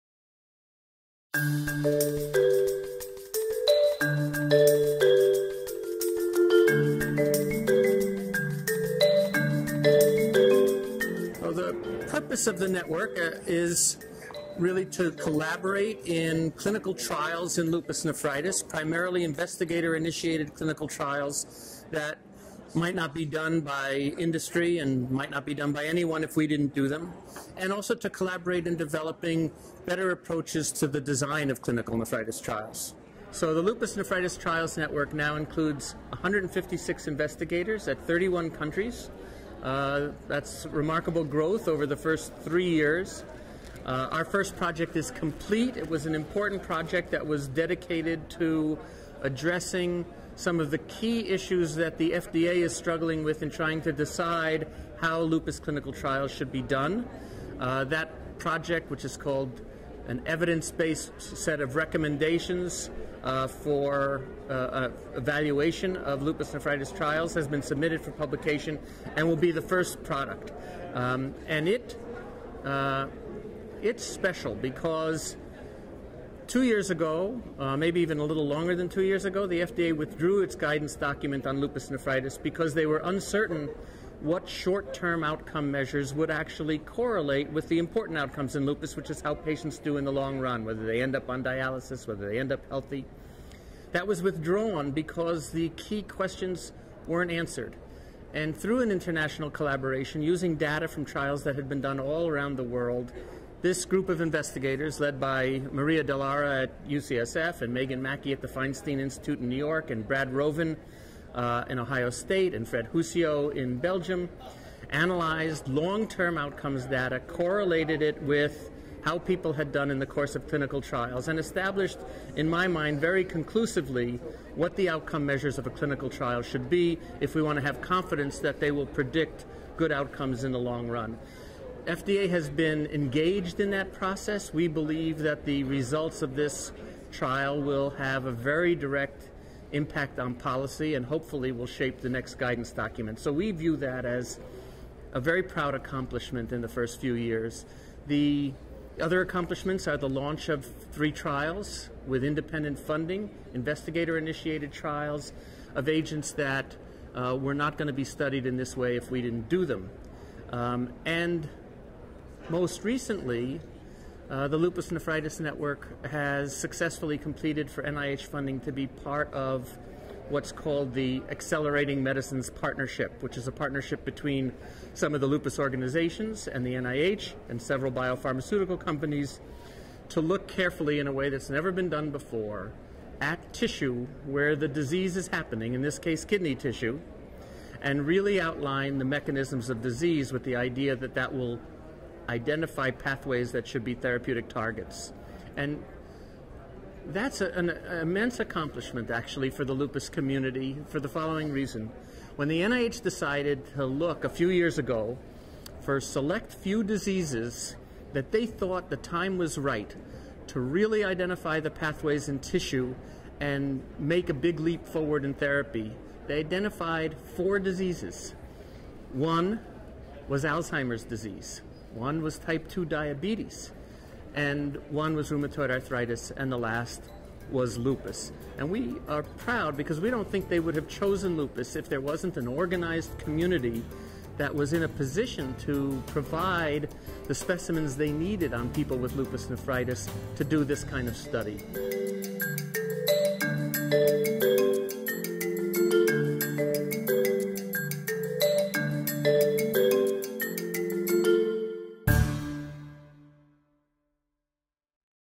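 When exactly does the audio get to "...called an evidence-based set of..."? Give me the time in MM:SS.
00:59.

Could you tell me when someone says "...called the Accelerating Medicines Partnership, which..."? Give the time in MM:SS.
02:50.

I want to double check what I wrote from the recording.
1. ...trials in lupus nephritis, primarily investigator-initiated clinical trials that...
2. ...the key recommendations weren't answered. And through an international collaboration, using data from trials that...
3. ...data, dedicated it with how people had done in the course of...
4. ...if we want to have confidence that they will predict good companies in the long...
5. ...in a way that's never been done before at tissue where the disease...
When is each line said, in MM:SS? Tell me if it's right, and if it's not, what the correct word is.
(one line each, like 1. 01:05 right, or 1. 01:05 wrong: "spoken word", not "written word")
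1. 00:16 right
2. 01:35 wrong: "questions", not "recommendations"
3. 01:56 wrong: "correlated", not "dedicated"
4. 02:07 wrong: "outcomes", not "companies"
5. 03:00 right.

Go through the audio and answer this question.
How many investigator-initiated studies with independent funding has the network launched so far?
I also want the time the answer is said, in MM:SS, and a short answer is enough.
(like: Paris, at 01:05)
3, at 02:30.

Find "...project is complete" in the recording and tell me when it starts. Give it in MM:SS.
00:44.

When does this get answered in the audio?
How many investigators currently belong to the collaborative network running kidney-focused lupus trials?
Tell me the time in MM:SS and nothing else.
00:36.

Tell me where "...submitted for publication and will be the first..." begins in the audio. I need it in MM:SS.
01:07.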